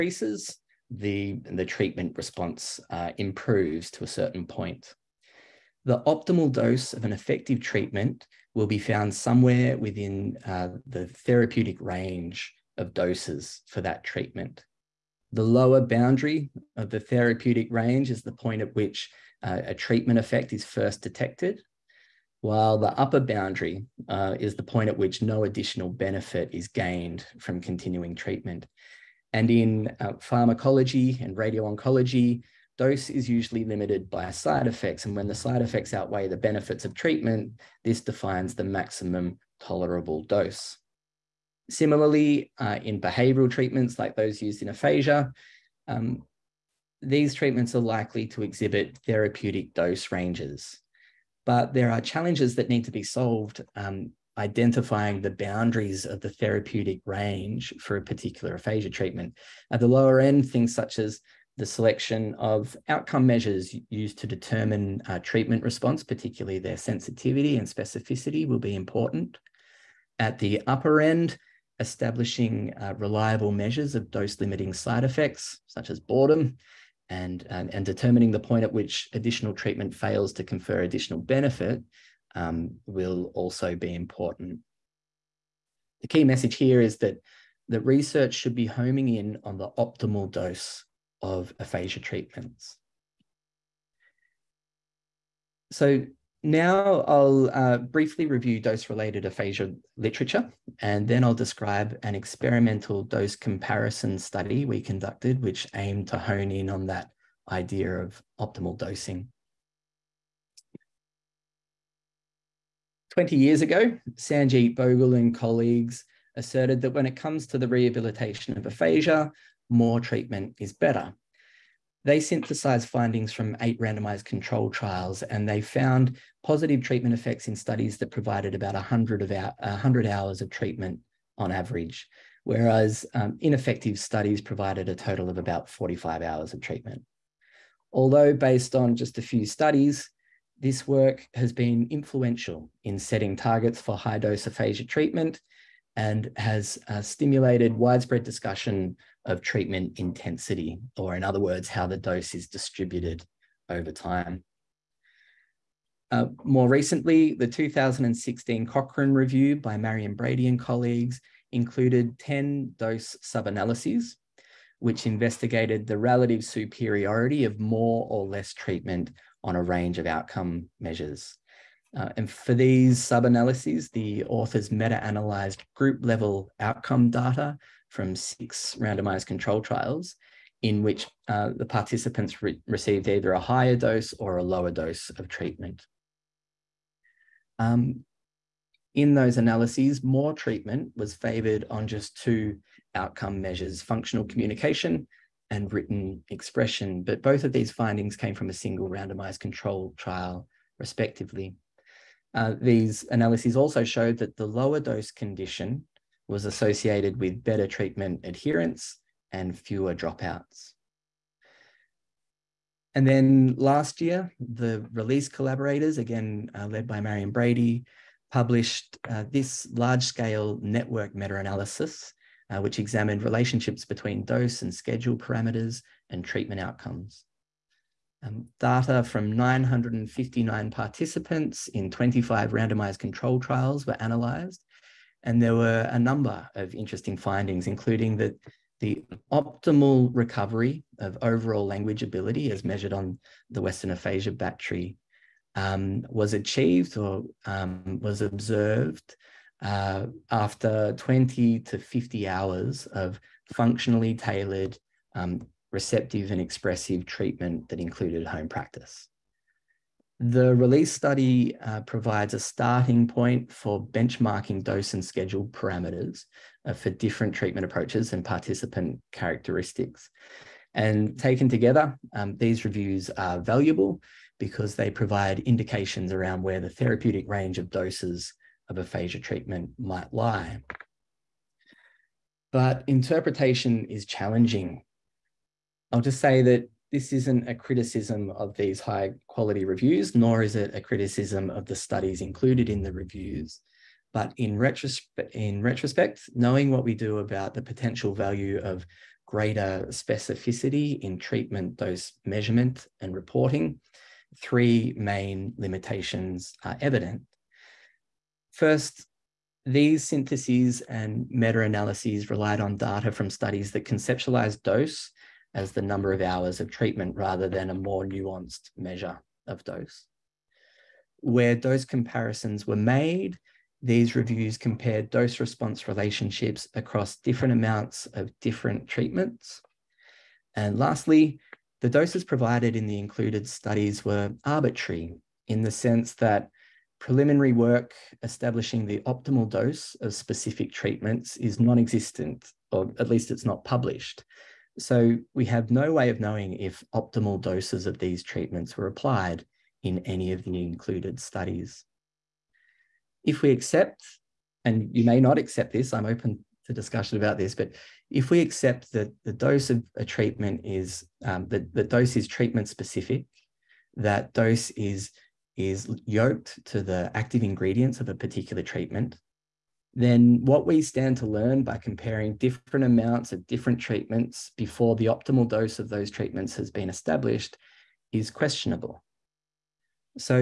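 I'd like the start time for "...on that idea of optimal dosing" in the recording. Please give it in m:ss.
1:46.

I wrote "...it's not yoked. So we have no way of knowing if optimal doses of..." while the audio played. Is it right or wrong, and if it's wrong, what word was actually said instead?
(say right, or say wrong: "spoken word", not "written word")
wrong: "published", not "yoked".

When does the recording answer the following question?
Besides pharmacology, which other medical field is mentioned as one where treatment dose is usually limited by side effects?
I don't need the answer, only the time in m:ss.
0:31.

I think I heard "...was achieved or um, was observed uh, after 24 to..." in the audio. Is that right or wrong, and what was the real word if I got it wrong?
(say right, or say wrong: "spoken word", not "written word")
wrong: "20", not "24".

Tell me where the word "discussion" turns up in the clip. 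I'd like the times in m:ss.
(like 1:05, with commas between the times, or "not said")
2:28, 5:56.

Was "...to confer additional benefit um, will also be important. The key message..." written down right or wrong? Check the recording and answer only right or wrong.
right.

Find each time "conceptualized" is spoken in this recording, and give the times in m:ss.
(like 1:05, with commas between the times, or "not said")
5:13.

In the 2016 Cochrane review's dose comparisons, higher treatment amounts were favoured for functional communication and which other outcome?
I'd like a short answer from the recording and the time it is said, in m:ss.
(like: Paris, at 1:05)
written expression, at 3:15.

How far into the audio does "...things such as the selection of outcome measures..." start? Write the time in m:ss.
1:00.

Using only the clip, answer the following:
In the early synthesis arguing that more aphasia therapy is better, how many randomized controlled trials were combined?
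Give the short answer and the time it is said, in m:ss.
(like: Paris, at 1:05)
8, at 2:03.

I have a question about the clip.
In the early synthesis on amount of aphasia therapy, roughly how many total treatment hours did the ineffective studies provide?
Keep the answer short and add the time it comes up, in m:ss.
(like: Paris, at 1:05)
45 hours, at 2:15.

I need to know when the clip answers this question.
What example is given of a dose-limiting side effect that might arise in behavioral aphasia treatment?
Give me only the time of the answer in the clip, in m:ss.
1:16.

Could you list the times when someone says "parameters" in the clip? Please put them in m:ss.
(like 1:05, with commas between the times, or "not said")
3:45, 4:25.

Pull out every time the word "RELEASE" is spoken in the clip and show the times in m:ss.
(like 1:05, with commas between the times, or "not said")
3:34, 4:20.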